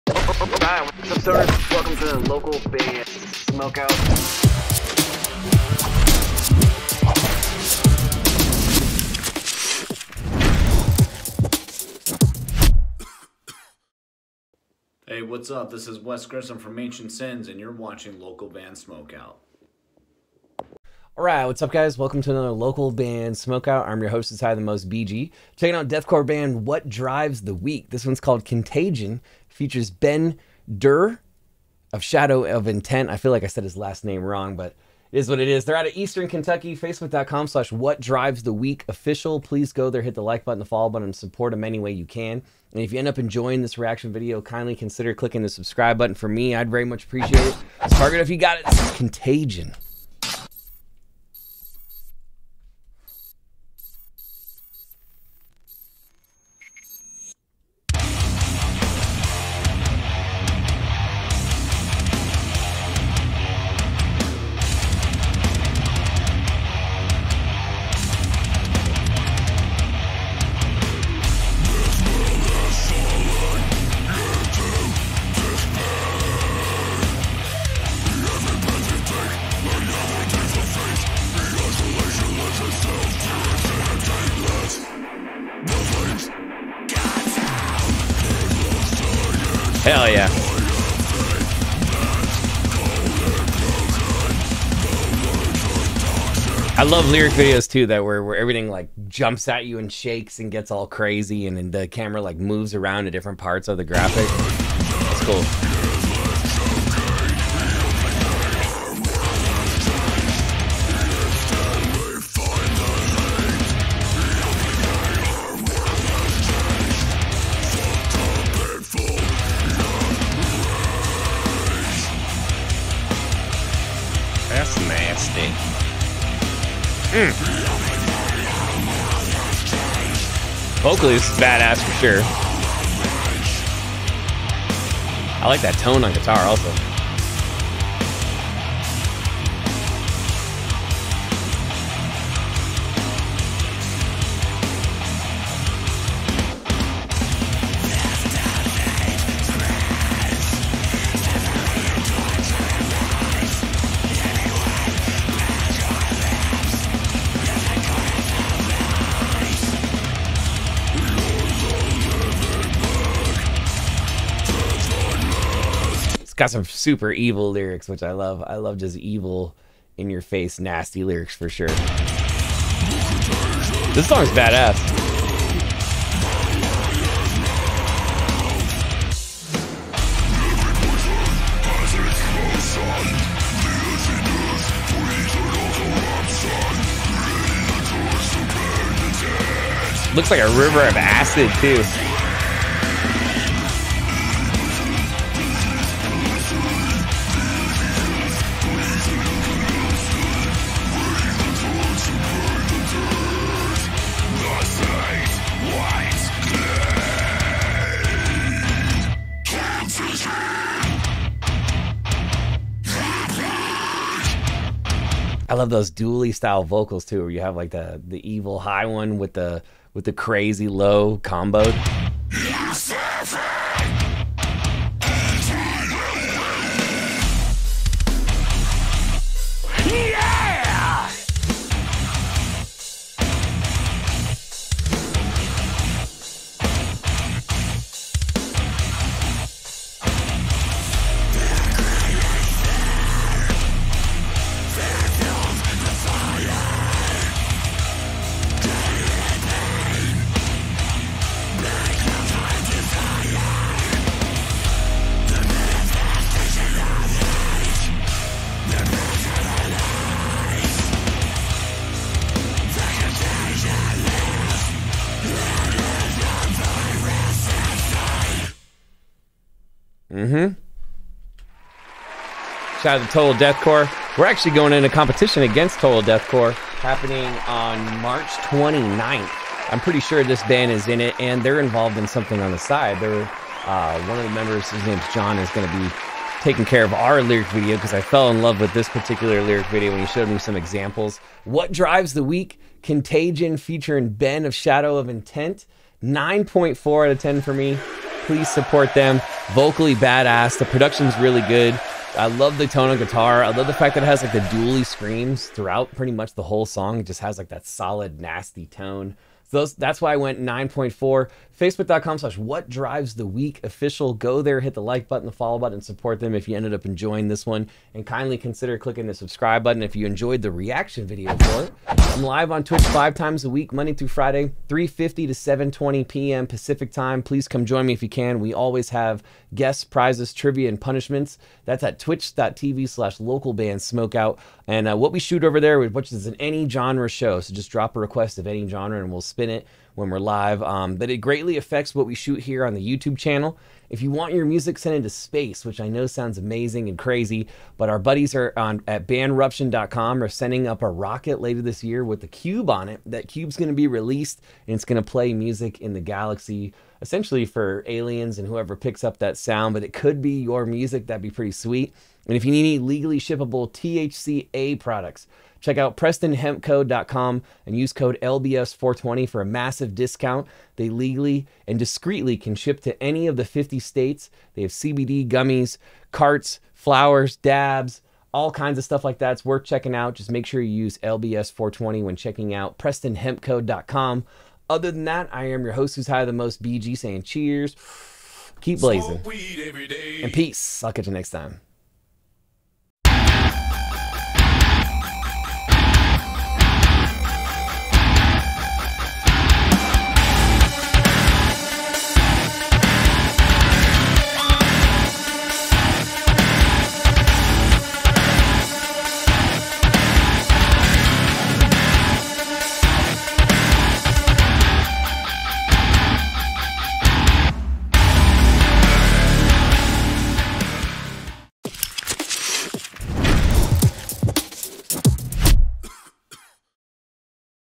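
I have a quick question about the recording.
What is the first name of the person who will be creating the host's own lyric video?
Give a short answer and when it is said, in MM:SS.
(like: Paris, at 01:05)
John, at 04:45.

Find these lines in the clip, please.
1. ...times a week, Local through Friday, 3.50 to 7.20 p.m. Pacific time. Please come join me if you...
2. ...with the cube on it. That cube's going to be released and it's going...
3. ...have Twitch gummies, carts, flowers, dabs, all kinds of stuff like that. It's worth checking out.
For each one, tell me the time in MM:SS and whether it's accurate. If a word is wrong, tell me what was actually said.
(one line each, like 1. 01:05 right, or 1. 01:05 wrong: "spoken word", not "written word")
1. 05:23 wrong: "Monday", not "Local"
2. 05:52 right
3. 06:14 wrong: "CBD", not "Twitch".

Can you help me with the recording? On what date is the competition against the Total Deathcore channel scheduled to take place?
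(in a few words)
March 29.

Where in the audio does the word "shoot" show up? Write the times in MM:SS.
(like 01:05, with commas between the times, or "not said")
05:35, 05:42.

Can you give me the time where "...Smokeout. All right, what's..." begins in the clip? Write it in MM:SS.
00:18.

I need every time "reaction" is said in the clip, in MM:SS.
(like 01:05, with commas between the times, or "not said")
00:43, 05:20.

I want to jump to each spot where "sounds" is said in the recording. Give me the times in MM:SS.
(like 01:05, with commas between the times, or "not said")
05:46, 05:59.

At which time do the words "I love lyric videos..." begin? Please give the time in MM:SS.
01:36.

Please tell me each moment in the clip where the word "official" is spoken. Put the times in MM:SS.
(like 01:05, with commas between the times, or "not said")
00:38, 05:13.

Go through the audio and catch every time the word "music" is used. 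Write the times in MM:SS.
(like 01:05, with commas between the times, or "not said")
05:44, 05:55, 06:00.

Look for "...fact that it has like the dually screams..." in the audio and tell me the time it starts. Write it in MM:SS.
05:03.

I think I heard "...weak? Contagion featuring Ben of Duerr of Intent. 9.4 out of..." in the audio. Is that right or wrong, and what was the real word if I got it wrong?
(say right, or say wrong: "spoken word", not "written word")
wrong: "Shadow", not "Duerr".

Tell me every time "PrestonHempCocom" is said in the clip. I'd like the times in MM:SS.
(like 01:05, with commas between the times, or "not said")
06:05, 06:22.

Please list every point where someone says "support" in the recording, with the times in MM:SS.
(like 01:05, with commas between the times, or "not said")
00:41, 04:58, 05:15.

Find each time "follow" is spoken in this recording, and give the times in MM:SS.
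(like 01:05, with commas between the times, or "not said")
00:40, 05:15.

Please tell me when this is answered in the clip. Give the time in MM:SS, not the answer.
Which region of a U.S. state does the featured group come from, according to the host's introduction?
00:35.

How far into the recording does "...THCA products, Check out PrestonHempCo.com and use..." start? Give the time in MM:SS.
06:03.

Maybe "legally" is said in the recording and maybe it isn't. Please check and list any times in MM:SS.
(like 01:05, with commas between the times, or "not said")
06:02, 06:10.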